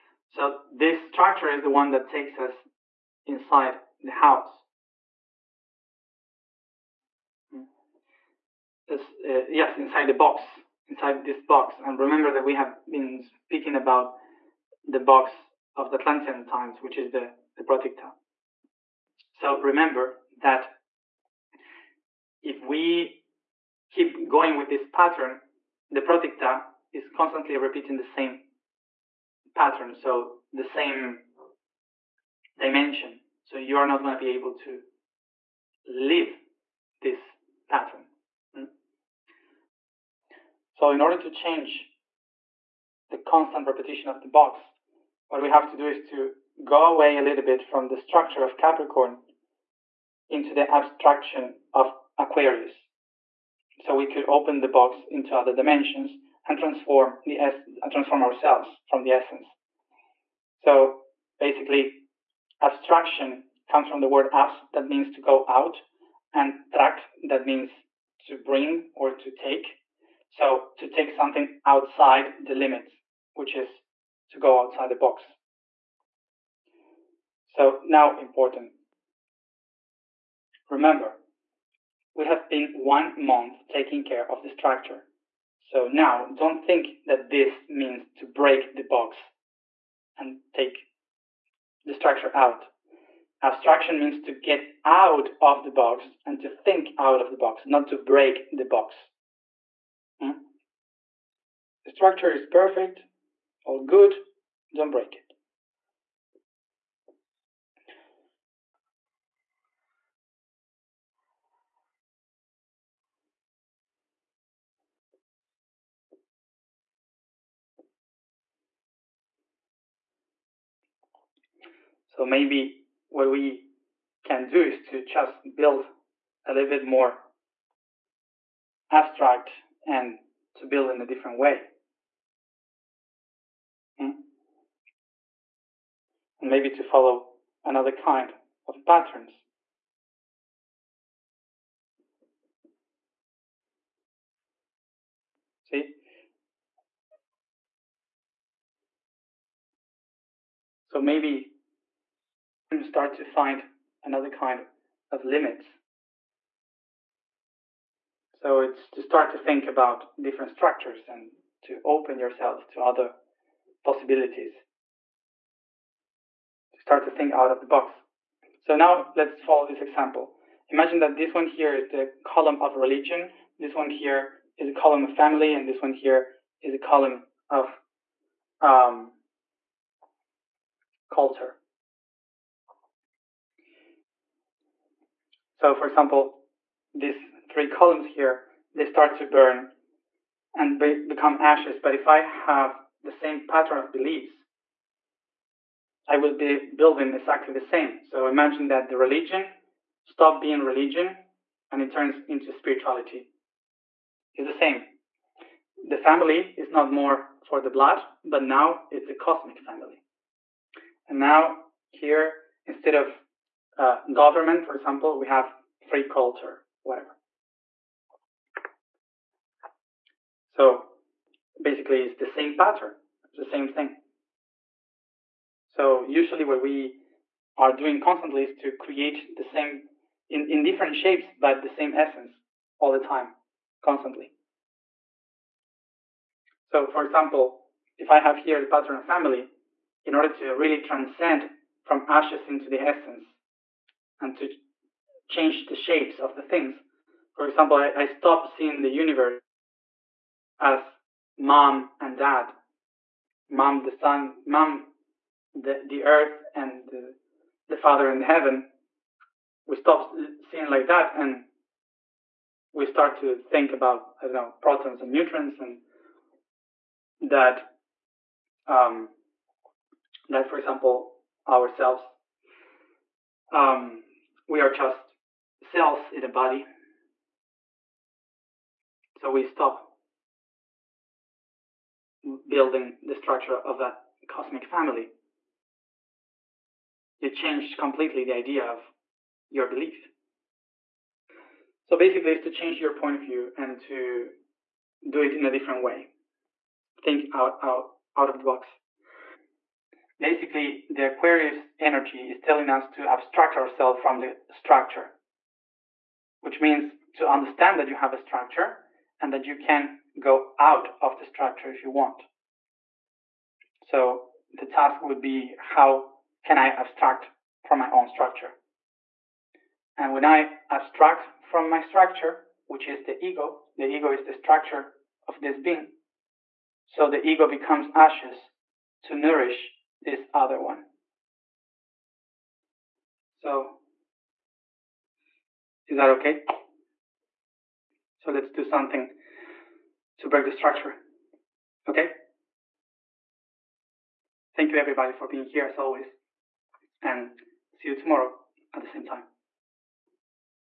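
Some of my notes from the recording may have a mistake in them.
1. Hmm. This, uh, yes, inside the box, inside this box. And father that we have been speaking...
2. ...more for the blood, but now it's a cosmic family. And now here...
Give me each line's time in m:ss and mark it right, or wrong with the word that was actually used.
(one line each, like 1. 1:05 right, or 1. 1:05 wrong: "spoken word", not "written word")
1. 0:07 wrong: "remember", not "father"
2. 3:26 right.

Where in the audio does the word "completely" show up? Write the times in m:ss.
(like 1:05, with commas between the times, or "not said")
4:47.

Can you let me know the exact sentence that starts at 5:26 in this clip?
So the ego becomes ashes to nourish this other one.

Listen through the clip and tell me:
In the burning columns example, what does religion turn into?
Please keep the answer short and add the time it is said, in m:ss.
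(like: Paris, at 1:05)
Spirituality, at 3:22.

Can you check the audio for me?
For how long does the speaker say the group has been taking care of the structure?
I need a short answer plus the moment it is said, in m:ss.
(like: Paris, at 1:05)
One month, at 1:22.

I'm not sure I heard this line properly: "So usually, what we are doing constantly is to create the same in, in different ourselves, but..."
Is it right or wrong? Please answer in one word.
wrong.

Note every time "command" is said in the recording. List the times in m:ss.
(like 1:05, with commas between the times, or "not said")
not said.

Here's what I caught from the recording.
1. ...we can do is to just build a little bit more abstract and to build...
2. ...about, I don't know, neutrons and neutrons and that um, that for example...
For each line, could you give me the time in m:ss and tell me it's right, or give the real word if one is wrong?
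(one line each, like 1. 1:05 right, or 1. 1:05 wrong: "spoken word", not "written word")
1. 2:03 right
2. 4:23 wrong: "protons", not "neutrons".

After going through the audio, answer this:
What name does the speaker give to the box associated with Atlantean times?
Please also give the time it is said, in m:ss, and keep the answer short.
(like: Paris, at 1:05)
Proticta, at 0:17.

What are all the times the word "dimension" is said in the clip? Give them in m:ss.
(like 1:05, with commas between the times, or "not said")
0:32, 0:55.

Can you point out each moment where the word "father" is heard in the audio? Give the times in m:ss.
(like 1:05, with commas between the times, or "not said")
4:17.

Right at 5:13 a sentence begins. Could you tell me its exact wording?
So the task would be how can I abstract from my own structure?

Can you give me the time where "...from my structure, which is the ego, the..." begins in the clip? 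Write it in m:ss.
5:21.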